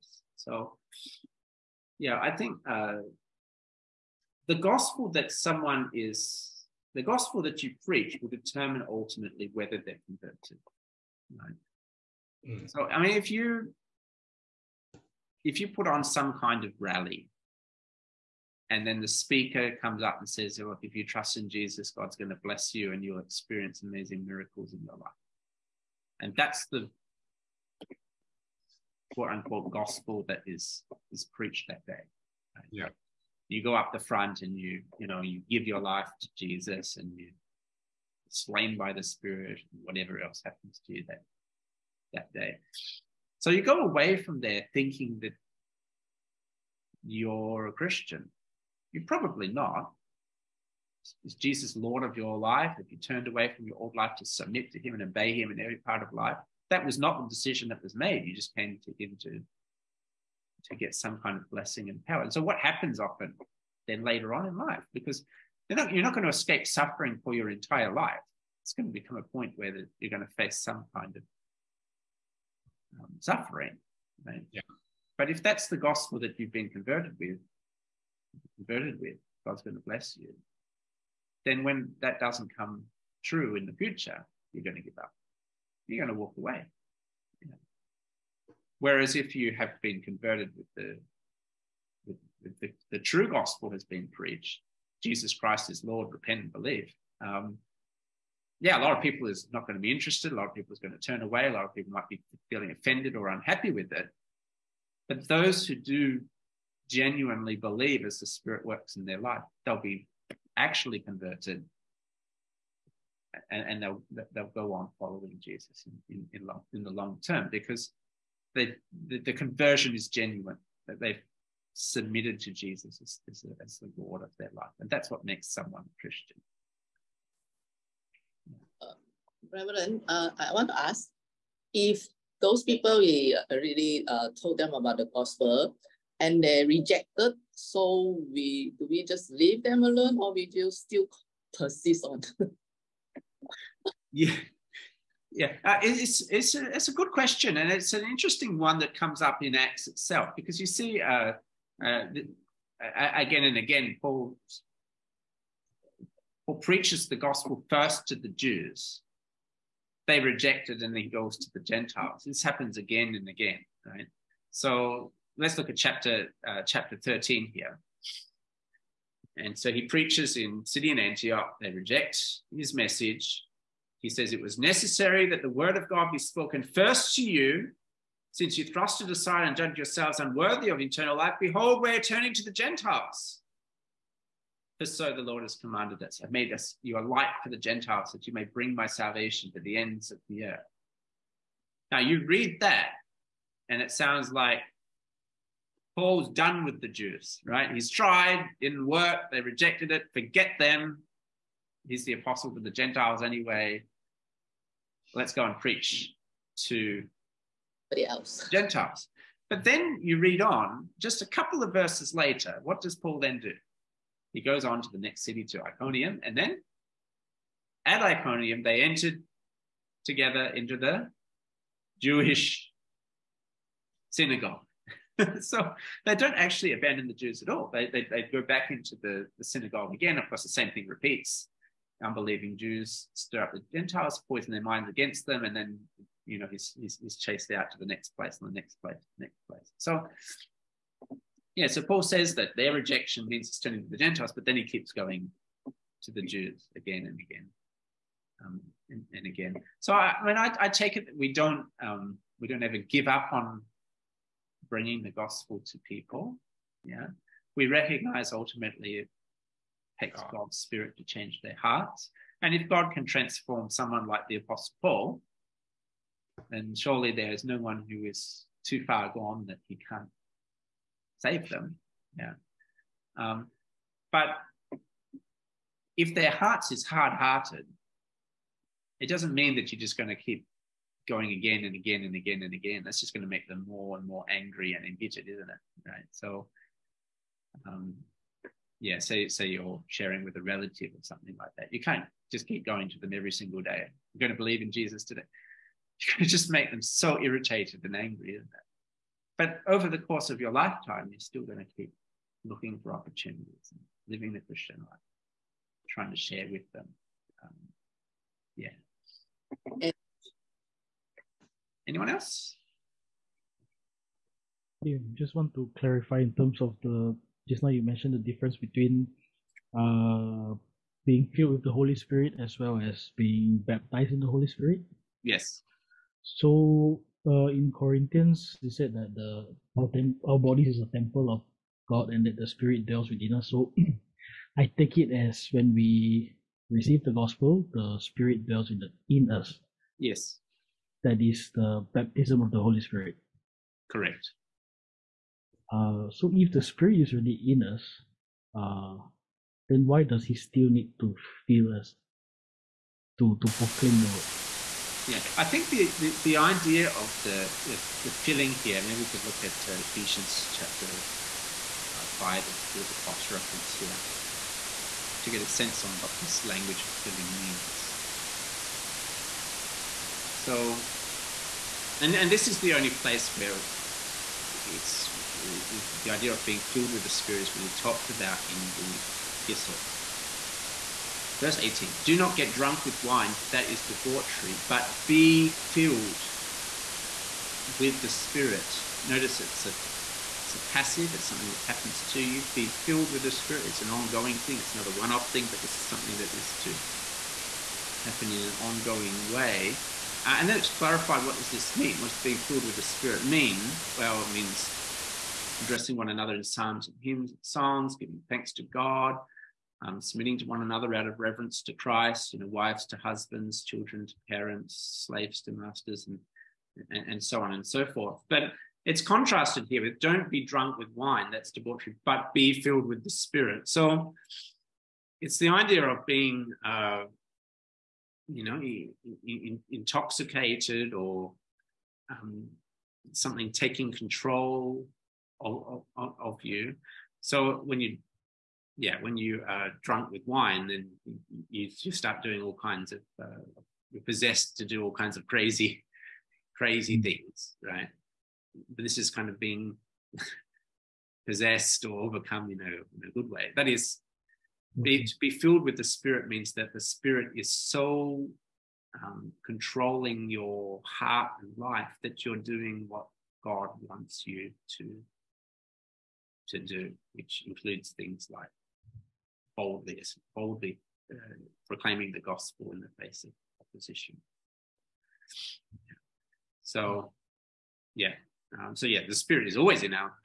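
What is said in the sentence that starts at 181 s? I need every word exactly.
Behold, we're turning to the Gentiles.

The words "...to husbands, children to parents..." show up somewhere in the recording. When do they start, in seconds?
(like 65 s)
412 s.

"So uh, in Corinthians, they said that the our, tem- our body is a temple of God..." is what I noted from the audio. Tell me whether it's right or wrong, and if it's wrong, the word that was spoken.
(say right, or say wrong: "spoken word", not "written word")
right.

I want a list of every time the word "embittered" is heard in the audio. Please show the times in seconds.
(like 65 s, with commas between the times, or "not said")
284 s.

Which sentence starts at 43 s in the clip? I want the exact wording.
So you go away from there thinking that you're a Christian you're probably not.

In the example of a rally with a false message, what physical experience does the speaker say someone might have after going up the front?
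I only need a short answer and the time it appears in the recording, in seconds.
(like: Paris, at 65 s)
Slain by the spirit, at 38 s.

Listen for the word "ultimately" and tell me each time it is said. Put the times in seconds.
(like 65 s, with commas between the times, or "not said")
8 s, 258 s.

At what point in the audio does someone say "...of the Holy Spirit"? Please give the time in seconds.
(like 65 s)
342 s.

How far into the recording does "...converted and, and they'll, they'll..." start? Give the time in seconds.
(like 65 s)
110 s.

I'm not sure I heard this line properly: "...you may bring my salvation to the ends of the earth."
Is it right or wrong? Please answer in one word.
right.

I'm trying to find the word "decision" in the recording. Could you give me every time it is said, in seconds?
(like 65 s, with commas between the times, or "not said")
57 s.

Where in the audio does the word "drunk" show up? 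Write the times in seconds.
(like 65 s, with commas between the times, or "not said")
382 s, 420 s, 439 s.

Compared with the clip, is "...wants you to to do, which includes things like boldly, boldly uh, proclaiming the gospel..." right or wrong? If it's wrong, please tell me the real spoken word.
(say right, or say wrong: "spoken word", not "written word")
right.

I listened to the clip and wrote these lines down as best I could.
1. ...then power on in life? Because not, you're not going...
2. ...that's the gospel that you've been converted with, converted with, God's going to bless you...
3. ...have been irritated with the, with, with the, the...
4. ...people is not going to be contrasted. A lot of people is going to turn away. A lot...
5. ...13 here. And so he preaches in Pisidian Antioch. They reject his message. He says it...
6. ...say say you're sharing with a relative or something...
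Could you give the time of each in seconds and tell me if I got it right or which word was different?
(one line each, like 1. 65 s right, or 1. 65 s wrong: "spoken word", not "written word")
1. 63 s wrong: "later", not "power"
2. 75 s right
3. 89 s wrong: "converted", not "irritated"
4. 99 s wrong: "interested", not "contrasted"
5. 166 s right
6. 288 s right.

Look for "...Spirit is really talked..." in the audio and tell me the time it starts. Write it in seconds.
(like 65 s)
377 s.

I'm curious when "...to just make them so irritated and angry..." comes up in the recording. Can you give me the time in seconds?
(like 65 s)
296 s.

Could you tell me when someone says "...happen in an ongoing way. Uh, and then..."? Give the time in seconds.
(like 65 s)
398 s.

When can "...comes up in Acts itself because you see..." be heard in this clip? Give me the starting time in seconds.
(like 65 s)
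148 s.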